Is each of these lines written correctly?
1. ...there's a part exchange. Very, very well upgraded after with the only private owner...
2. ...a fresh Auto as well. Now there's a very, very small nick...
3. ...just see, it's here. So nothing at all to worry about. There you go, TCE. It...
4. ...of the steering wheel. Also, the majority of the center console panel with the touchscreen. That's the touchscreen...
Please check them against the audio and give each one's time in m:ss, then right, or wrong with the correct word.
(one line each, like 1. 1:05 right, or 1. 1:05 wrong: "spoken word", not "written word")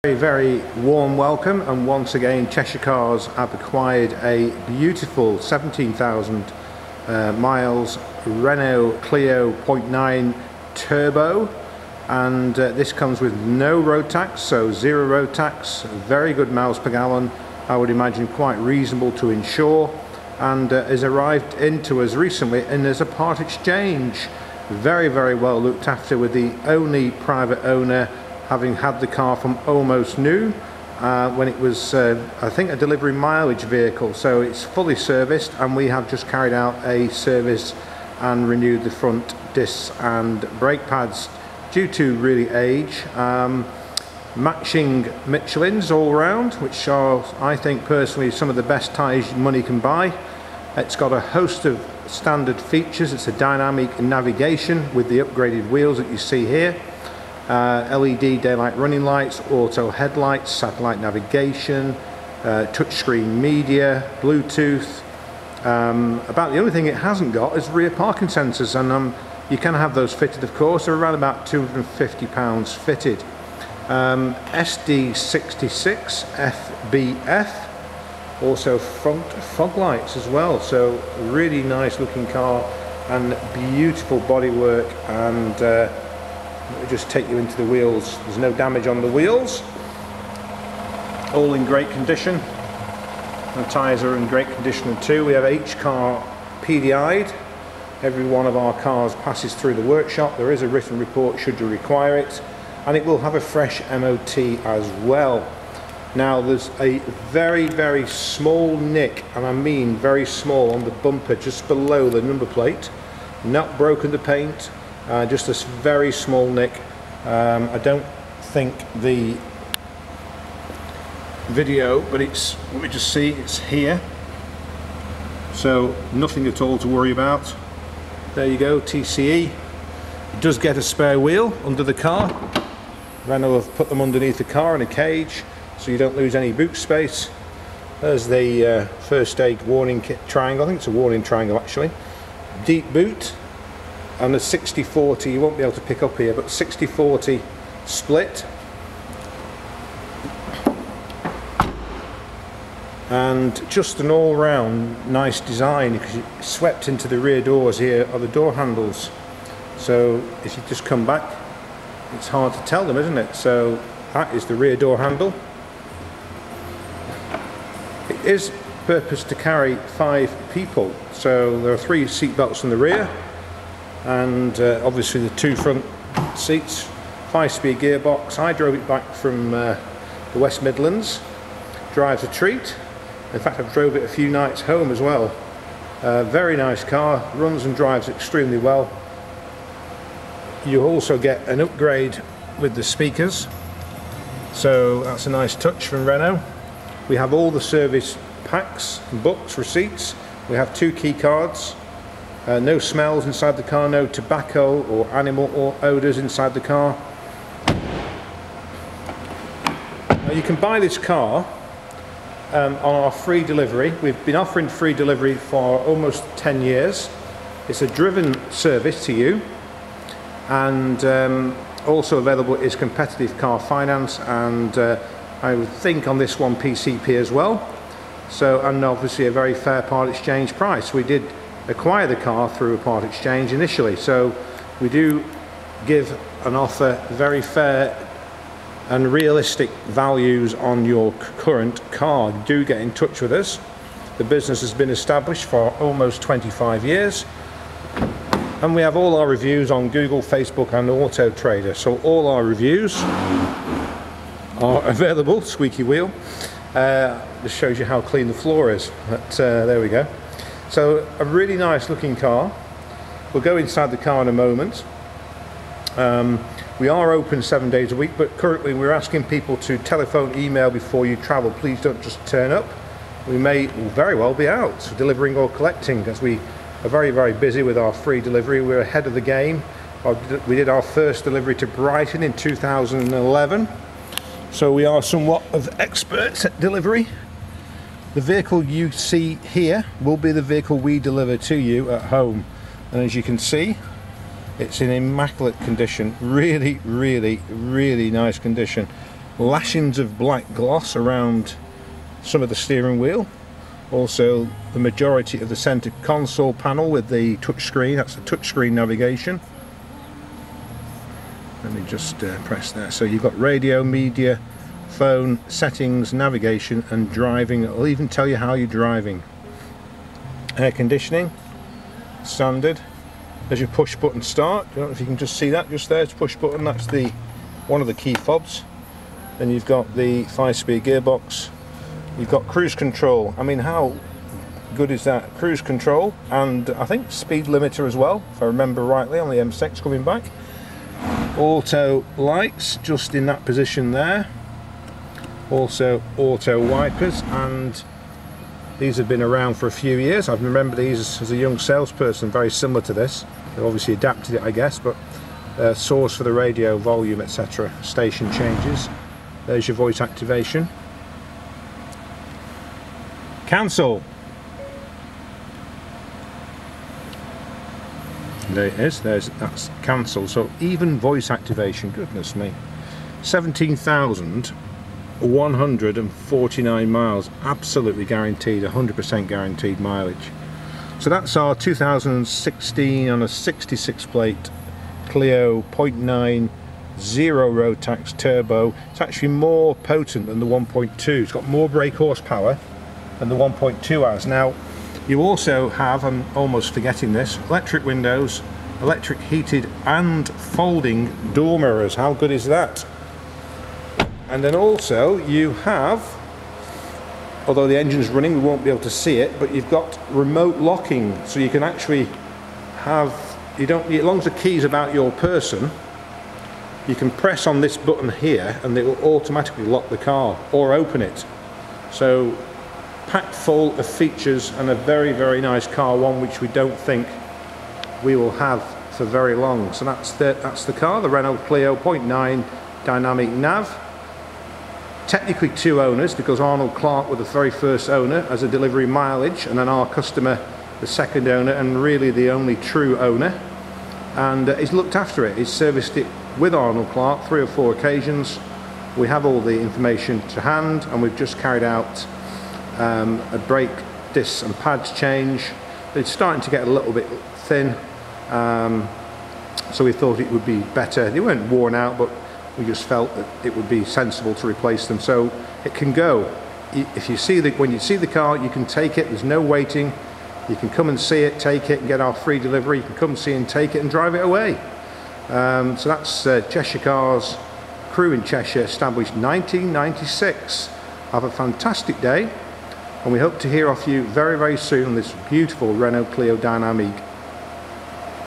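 1. 0:22 wrong: "looked", not "upgraded"
2. 1:43 wrong: "MOT", not "Auto"
3. 2:02 right
4. 5:02 right.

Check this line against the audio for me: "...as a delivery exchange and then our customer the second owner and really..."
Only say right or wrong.
wrong.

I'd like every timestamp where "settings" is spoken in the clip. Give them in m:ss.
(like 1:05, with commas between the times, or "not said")
5:15.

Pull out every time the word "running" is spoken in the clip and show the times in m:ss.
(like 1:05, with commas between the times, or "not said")
0:58, 6:48.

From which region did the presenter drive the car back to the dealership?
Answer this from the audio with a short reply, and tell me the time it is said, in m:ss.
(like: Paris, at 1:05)
West Midlands, at 3:00.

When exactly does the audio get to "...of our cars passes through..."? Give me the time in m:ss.
1:38.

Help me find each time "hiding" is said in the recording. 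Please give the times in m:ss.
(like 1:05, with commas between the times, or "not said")
not said.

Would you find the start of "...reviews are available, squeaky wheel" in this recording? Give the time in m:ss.
4:12.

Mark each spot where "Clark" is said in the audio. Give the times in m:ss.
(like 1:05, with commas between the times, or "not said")
7:16, 7:26.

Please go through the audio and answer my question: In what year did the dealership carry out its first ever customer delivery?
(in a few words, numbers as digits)
2011.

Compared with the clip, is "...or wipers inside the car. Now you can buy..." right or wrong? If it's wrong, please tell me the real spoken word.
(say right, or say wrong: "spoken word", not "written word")
wrong: "odours", not "wipers".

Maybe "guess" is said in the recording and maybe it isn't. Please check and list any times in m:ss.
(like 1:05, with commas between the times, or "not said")
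5:54.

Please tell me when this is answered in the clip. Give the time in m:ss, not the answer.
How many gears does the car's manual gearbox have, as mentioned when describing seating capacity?
2:57.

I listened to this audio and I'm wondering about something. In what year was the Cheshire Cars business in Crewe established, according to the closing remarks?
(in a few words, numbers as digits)
1996.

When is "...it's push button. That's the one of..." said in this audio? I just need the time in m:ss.
5:26.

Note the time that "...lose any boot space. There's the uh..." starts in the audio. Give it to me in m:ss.
2:16.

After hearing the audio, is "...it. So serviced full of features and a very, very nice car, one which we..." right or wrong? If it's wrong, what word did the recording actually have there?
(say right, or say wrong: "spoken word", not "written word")
wrong: "packed", not "serviced".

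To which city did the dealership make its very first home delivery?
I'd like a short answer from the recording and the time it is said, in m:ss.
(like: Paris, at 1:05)
Brighton, at 4:41.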